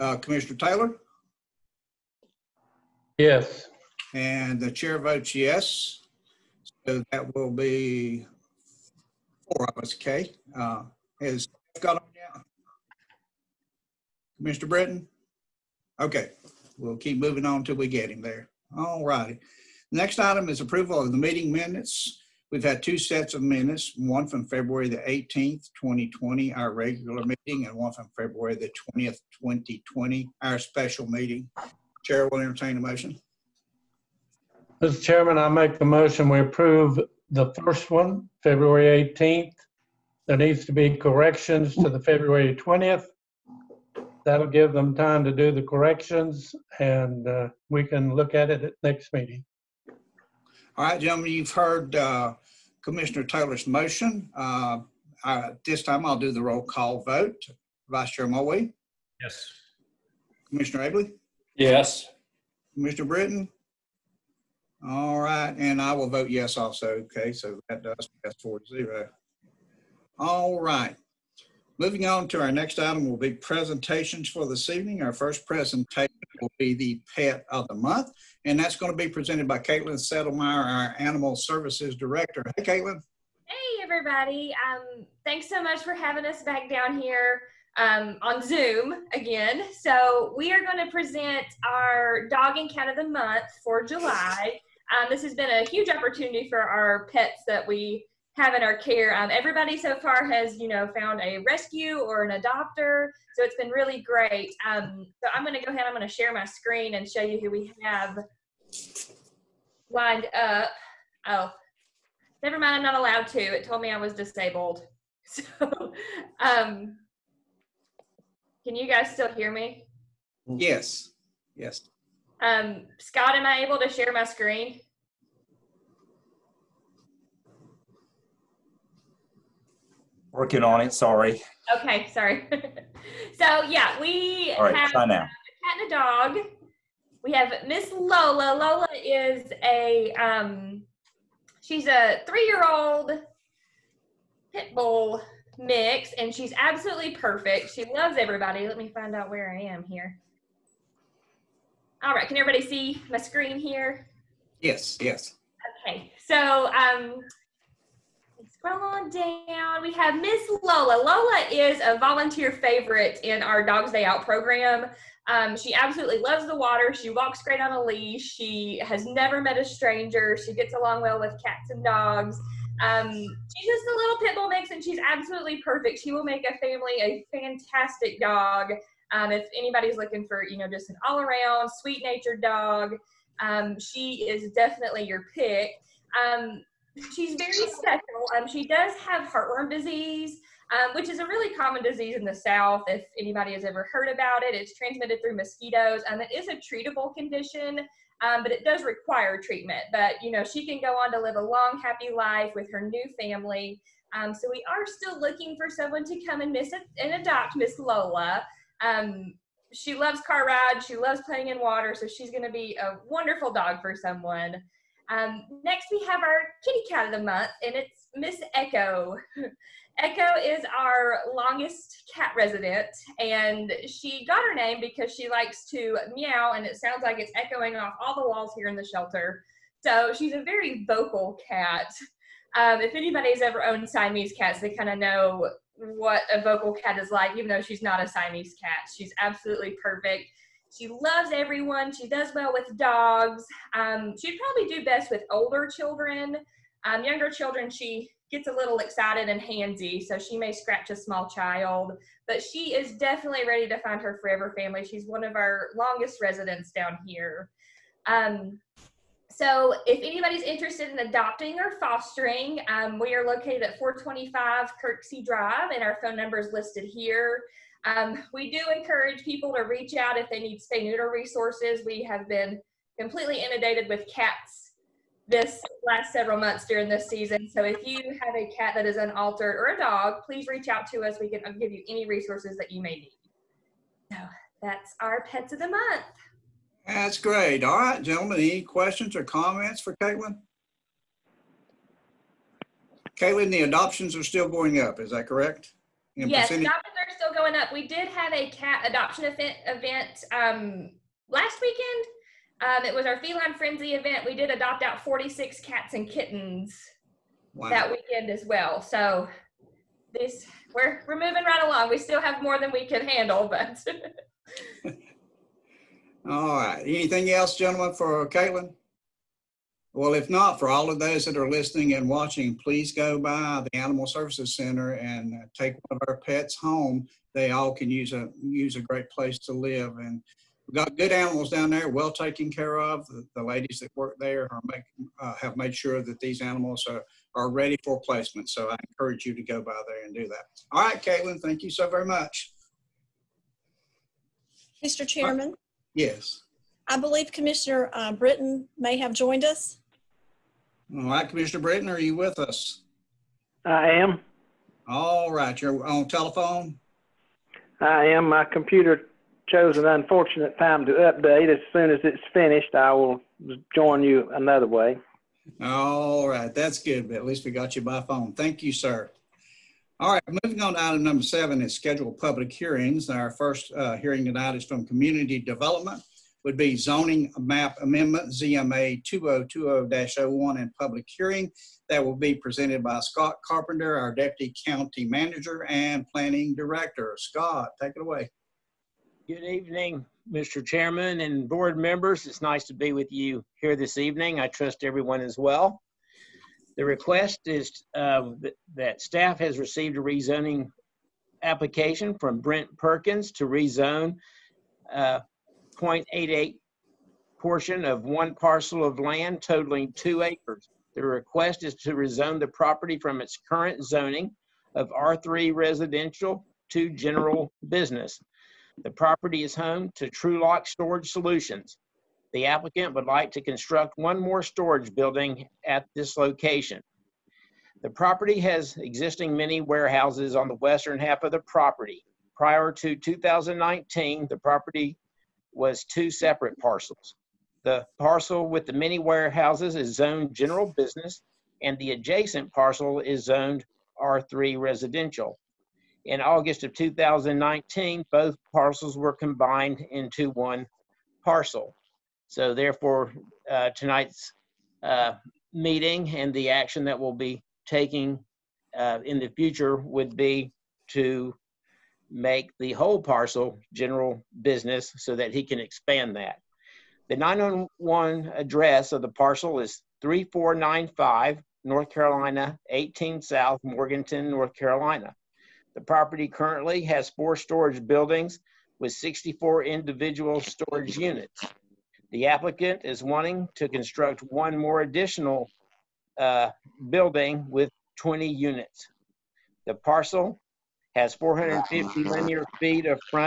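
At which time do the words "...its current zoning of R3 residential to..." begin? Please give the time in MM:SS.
06:53.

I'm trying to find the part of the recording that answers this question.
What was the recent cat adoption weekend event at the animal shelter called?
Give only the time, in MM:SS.
05:03.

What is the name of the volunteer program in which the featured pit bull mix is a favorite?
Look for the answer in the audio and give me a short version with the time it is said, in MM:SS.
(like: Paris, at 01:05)
Dogs Day Out, at 02:43.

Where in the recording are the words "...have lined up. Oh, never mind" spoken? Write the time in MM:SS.
01:47.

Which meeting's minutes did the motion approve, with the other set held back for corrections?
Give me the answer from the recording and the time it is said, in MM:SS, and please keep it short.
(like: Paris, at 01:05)
February 18th, at 00:38.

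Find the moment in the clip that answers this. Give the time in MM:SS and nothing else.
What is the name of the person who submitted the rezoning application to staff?
06:42.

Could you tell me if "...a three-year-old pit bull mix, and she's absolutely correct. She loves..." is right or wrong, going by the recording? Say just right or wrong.
wrong.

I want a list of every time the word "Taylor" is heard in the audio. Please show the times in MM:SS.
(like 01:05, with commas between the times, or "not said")
00:00, 00:53.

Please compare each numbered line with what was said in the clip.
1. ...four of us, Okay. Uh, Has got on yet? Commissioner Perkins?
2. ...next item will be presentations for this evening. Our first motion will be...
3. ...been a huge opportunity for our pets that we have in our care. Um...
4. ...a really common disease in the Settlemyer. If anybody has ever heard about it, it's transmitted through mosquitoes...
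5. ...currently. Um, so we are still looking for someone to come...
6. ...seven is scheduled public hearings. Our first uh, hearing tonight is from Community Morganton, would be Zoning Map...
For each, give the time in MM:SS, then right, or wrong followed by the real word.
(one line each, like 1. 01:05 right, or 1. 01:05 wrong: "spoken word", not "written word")
1. 00:09 wrong: "Brittain", not "Perkins"
2. 01:12 wrong: "presentation", not "motion"
3. 01:35 right
4. 03:11 wrong: "South", not "Settlemyer"
5. 03:23 wrong: "family", not "currently"
6. 06:11 wrong: "Development", not "Morganton".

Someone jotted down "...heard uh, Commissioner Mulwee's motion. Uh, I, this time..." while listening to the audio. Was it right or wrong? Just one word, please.
wrong.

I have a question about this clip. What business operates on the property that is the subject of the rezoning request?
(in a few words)
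Trulock Storage Solutions.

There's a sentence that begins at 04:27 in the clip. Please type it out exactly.
Um, we do encourage people to reach out if they need spay neuter resources.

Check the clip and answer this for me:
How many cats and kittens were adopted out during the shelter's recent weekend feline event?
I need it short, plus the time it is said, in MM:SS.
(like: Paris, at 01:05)
46, at 05:05.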